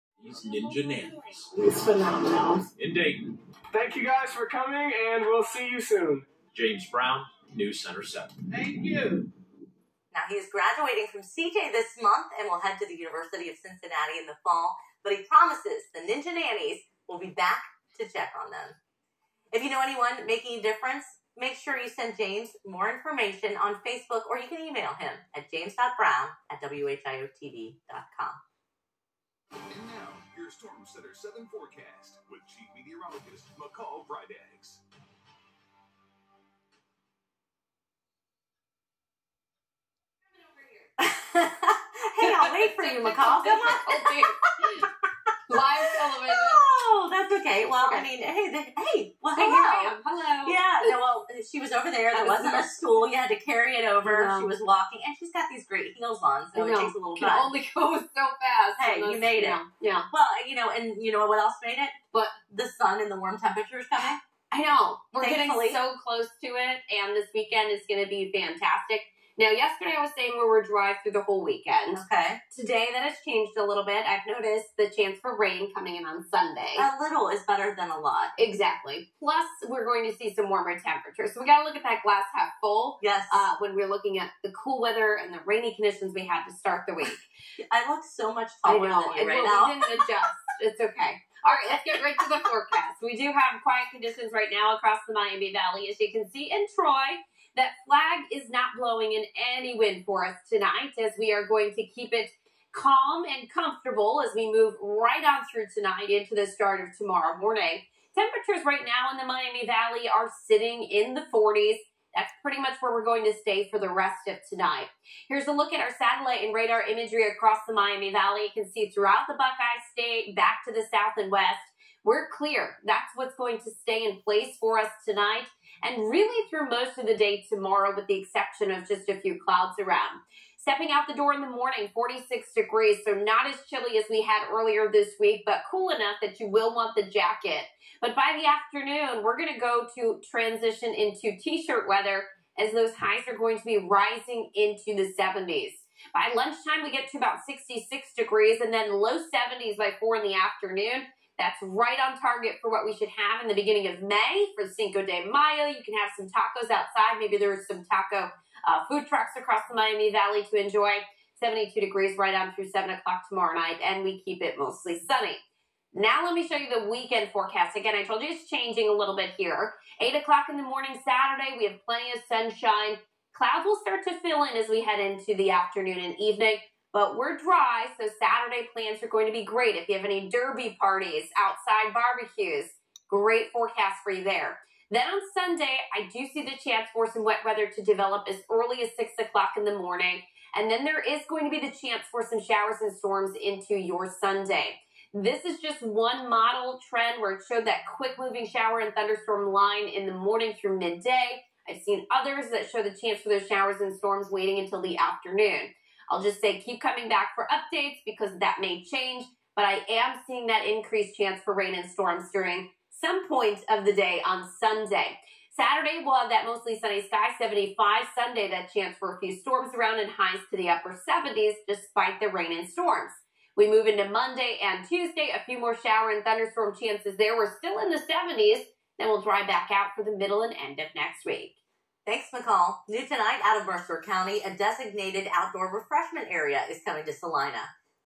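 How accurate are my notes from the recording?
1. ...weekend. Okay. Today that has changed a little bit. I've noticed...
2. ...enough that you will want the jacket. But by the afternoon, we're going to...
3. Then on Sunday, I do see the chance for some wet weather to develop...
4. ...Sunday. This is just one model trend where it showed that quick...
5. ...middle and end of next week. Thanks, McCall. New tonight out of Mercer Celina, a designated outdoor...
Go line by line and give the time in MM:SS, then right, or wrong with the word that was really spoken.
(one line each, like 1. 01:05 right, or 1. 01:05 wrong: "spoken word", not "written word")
1. 01:11 right
2. 02:15 right
3. 03:04 right
4. 03:14 right
5. 03:50 wrong: "County", not "Celina".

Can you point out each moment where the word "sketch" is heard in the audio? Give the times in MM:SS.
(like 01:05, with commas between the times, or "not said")
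not said.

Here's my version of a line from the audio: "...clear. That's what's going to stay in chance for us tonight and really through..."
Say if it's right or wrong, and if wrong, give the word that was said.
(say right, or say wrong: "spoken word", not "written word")
wrong: "place", not "chance".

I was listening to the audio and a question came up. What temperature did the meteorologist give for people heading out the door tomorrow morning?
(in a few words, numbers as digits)
46 degrees.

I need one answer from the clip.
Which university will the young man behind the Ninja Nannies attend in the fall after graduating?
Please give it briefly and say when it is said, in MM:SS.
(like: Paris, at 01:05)
University of Cincinnati, at 00:12.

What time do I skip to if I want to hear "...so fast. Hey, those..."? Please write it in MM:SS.
00:57.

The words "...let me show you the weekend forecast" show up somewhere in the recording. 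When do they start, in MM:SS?
02:46.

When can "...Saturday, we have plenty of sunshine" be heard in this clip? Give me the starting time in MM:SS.
02:51.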